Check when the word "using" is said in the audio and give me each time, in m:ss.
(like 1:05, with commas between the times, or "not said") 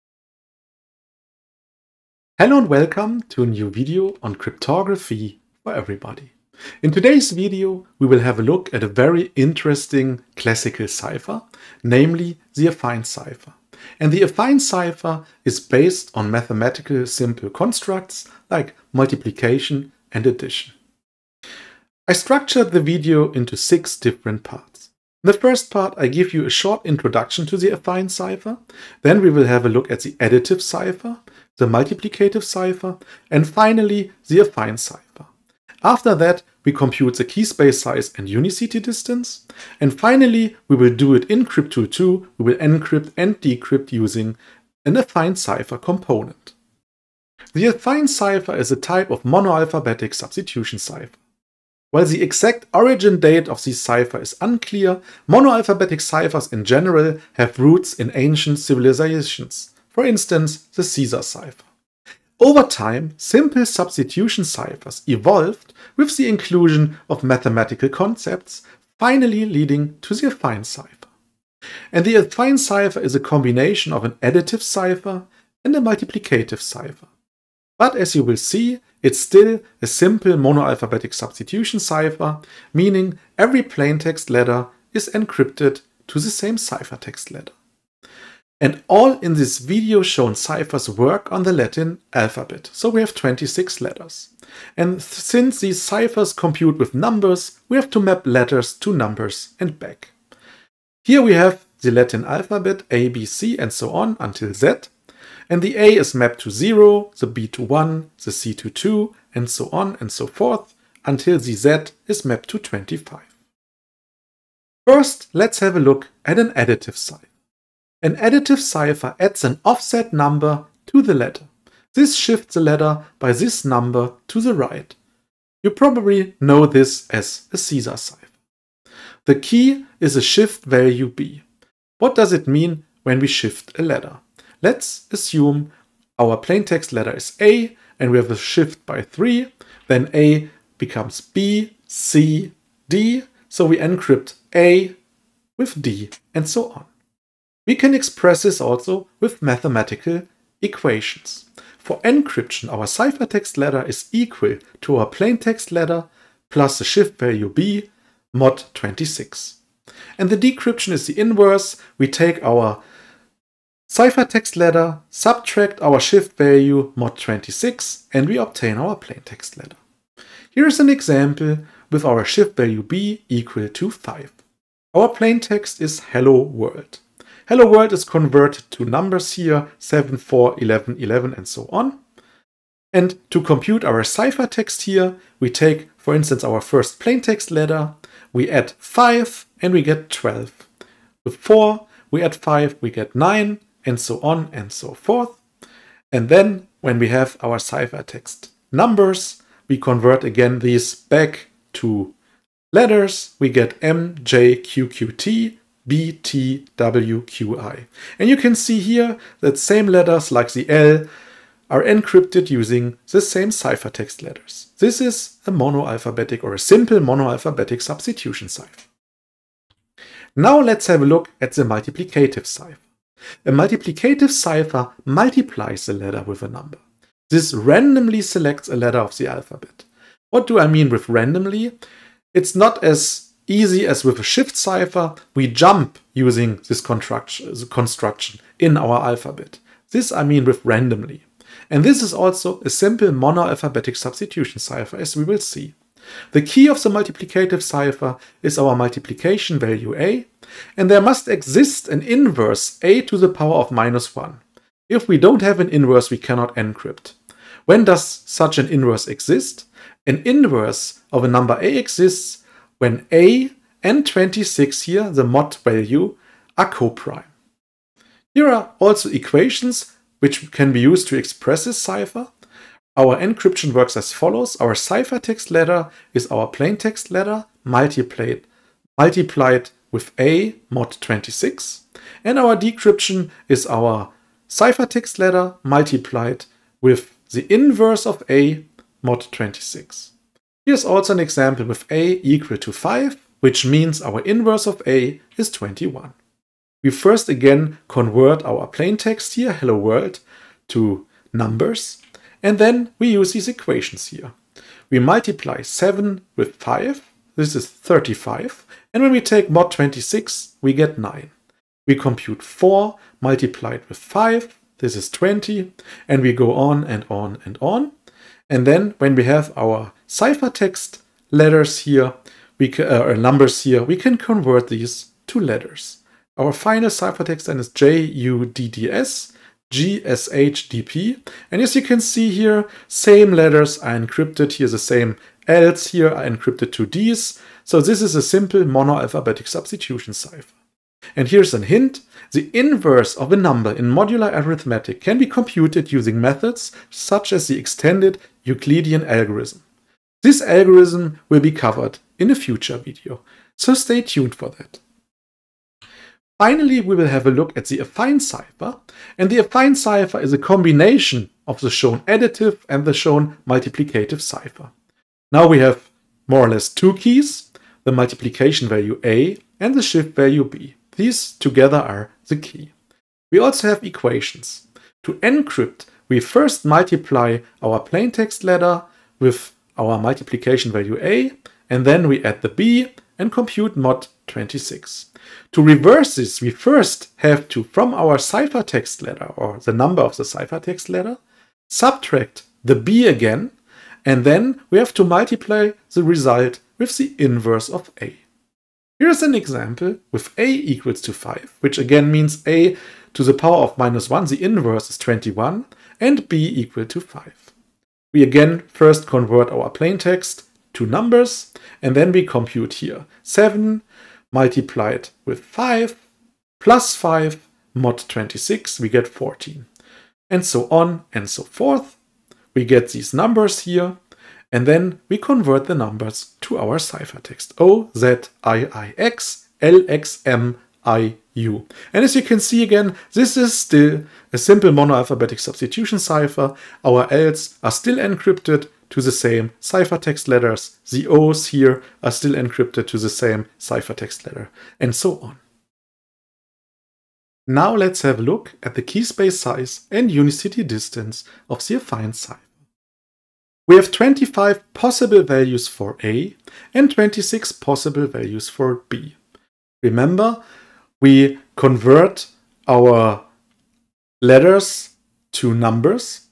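0:43, 3:32, 3:56, 5:45.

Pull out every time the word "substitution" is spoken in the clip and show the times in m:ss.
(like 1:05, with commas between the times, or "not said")
0:50, 1:03, 1:21, 3:37, 4:03, 5:39, 7:15.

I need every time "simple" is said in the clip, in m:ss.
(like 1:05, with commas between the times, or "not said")
0:17, 1:03, 1:19, 3:36, 4:02, 5:38, 7:14.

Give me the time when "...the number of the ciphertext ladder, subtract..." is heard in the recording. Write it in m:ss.
6:29.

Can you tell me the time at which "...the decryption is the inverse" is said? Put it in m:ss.
2:40.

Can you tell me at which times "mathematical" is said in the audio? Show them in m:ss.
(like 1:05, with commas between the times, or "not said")
0:16, 1:07, 2:29.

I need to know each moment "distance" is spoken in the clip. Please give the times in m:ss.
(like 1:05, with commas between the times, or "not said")
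0:38, 7:30.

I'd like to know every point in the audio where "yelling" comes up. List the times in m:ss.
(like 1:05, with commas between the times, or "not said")
not said.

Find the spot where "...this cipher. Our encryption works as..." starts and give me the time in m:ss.
4:31.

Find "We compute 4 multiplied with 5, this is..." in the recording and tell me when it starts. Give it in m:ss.
5:11.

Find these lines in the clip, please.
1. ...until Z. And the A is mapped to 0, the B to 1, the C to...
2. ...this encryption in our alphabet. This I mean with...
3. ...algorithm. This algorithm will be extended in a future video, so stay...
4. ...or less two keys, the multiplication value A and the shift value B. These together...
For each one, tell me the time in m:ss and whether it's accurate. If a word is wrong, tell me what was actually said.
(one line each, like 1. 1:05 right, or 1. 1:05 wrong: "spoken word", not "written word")
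1. 1:44 right
2. 3:56 wrong: "construction", not "encryption"
3. 5:49 wrong: "covered", not "extended"
4. 6:06 right.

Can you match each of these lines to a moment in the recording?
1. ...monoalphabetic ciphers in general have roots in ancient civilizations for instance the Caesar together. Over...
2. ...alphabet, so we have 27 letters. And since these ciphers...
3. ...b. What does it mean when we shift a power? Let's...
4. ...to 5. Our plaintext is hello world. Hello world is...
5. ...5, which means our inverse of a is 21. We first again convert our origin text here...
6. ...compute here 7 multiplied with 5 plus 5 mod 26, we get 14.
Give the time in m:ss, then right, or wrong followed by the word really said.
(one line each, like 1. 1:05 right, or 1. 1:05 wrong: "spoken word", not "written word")
1. 0:55 wrong: "cipher", not "together"
2. 1:32 wrong: "26", not "27"
3. 2:11 wrong: "letter", not "power"
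4. 2:53 right
5. 4:52 wrong: "plain", not "origin"
6. 6:52 right.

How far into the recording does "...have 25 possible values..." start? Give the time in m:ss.
7:33.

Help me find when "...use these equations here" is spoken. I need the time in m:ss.
5:03.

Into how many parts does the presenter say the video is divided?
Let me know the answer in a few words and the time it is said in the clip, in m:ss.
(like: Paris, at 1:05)
6, at 0:23.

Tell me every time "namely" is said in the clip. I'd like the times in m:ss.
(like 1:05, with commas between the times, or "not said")
0:11.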